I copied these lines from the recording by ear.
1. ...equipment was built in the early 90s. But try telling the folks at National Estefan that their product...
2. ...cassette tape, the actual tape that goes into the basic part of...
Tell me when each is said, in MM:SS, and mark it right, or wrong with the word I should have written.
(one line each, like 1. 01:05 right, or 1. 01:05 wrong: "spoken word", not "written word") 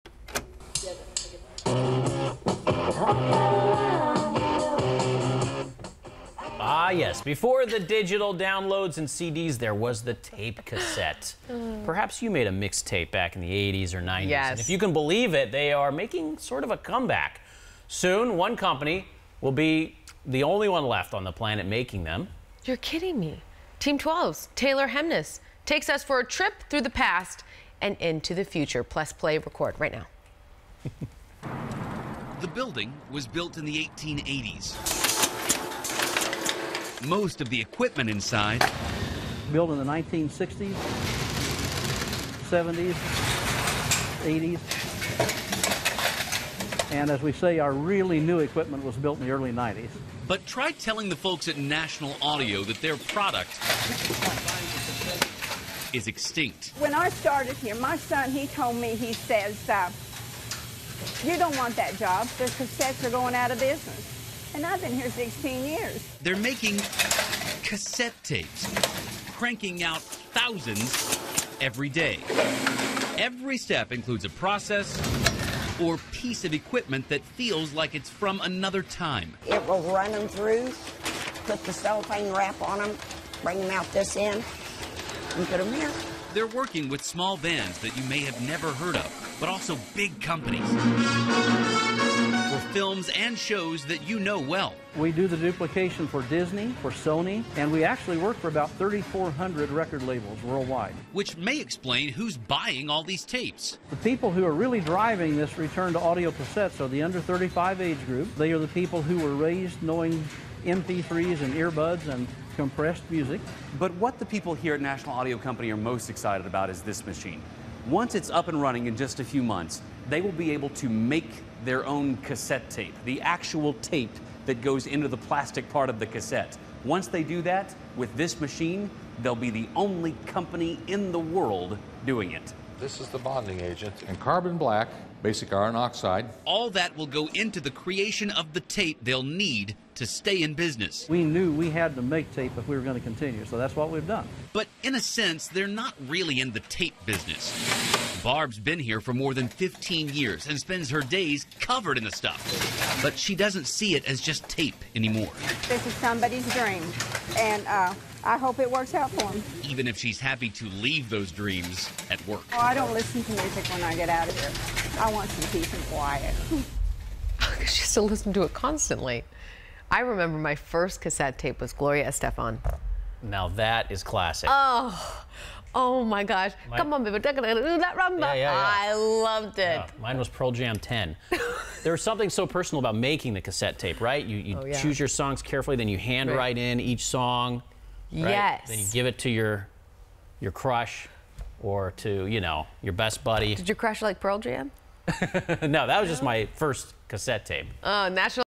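1. 00:48 wrong: "Audio", not "Estefan"
2. 02:02 wrong: "plastic", not "basic".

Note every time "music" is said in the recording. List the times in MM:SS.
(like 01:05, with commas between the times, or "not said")
01:53, 02:43.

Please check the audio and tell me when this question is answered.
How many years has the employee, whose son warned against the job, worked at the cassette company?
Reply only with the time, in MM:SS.
01:05.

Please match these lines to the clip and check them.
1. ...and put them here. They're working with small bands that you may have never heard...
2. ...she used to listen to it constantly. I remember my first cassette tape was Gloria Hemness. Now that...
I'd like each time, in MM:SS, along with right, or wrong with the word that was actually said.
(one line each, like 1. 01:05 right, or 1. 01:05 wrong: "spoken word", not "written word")
1. 01:25 right
2. 02:47 wrong: "Estefan", not "Hemness".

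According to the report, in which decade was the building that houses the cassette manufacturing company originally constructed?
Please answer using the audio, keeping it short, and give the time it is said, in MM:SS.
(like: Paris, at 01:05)
1880s, at 00:33.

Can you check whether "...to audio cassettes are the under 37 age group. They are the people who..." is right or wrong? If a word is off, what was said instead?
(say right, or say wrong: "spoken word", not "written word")
wrong: "35", not "37".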